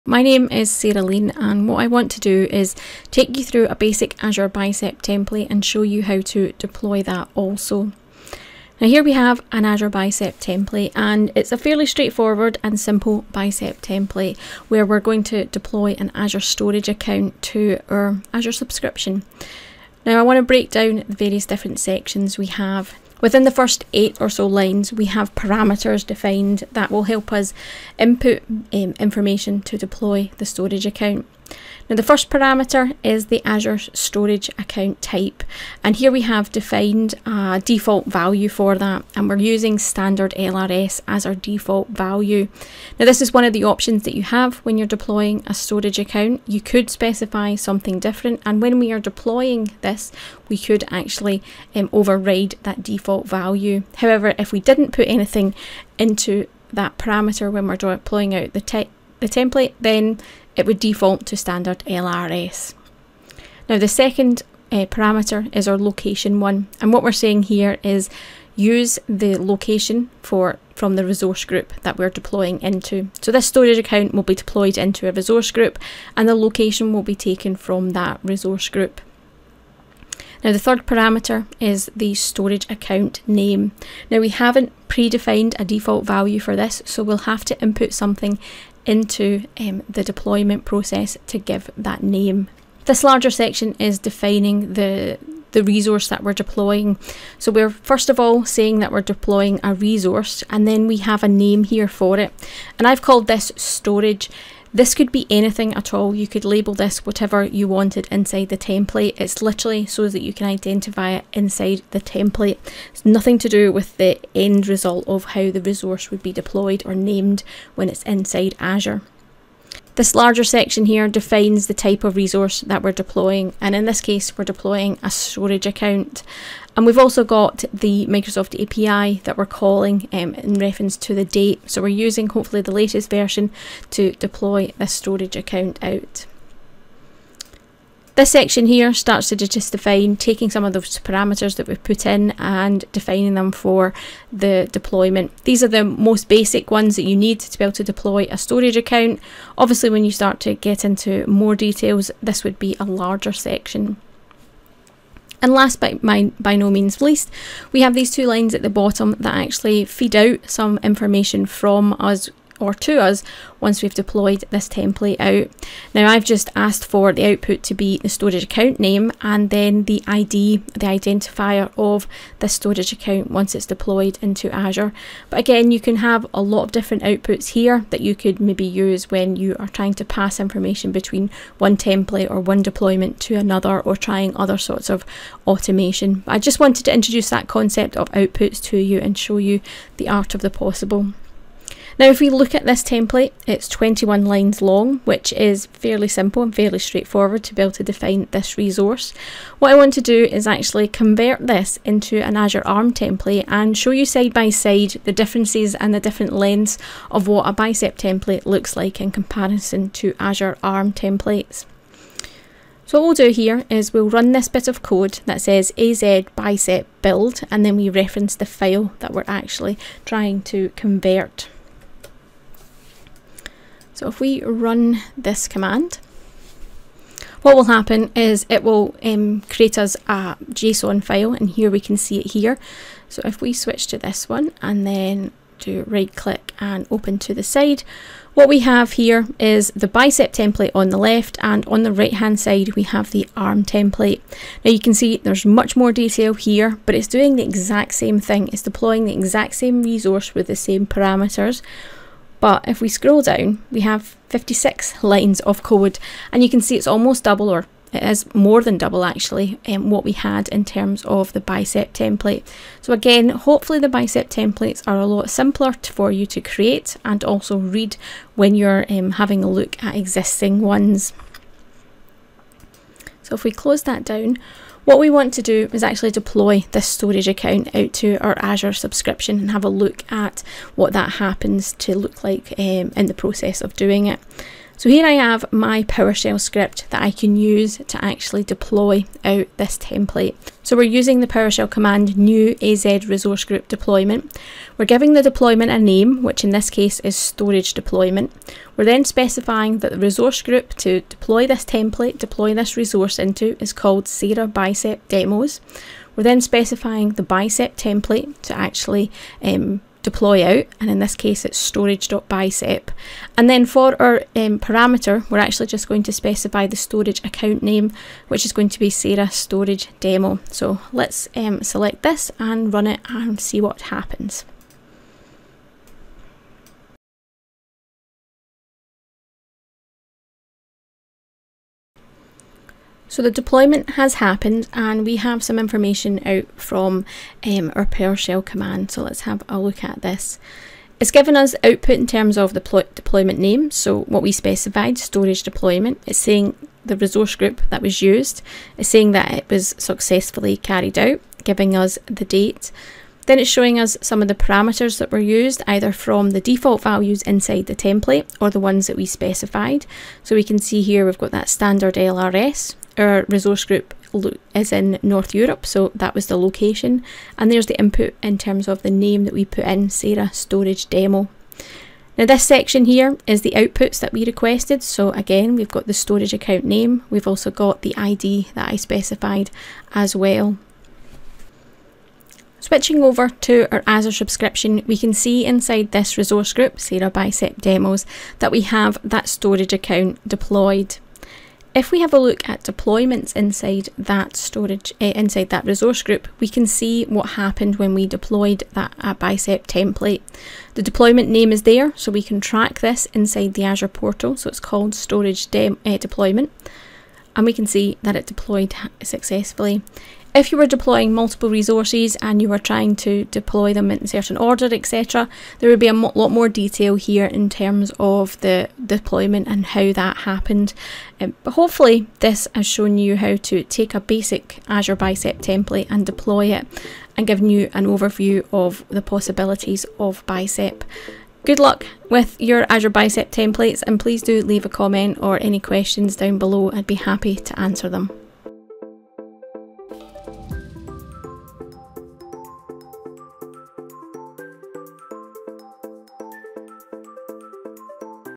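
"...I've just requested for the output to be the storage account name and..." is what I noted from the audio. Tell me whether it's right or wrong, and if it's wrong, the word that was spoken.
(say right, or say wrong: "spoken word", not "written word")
wrong: "asked", not "requested".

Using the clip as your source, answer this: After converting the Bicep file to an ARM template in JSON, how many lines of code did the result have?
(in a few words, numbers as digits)
56.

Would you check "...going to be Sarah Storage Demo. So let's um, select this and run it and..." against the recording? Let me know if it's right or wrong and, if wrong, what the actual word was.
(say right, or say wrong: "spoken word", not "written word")
right.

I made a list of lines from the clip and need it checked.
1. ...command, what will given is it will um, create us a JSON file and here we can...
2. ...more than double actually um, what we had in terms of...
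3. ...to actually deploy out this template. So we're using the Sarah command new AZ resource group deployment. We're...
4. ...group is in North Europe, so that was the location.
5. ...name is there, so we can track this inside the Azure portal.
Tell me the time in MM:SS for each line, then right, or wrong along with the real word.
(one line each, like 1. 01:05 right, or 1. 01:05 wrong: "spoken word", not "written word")
1. 03:45 wrong: "happen", not "given"
2. 04:18 right
3. 04:47 wrong: "PowerShell", not "Sarah"
4. 06:03 right
5. 06:41 right.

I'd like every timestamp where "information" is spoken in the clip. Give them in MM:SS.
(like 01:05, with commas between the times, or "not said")
00:28, 02:40, 03:00, 05:35.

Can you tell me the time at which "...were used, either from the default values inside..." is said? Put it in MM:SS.
05:55.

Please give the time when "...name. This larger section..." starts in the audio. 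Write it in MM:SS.
01:32.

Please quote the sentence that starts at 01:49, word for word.
It's literally so that you can identify it inside the template.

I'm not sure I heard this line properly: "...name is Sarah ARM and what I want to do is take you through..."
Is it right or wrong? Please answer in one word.
wrong.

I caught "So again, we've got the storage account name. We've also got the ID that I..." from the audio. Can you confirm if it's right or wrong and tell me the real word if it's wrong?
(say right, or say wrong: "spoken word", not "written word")
right.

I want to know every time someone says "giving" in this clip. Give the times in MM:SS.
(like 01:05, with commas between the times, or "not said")
04:54, 05:51.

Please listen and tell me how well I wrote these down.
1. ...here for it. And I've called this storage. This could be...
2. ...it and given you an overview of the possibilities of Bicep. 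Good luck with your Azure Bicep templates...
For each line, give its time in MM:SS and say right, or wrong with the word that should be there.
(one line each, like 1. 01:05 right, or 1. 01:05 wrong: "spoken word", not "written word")
1. 01:41 right
2. 07:06 right.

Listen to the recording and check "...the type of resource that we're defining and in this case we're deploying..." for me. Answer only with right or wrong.
wrong.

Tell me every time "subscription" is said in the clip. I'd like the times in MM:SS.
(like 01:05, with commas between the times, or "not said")
00:18, 04:38, 06:24.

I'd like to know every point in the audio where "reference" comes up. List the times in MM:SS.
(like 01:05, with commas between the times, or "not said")
02:10, 03:37.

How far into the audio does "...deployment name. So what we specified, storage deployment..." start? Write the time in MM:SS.
05:42.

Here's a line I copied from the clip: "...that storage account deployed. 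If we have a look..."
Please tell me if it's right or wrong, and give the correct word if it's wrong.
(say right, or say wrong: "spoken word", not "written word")
right.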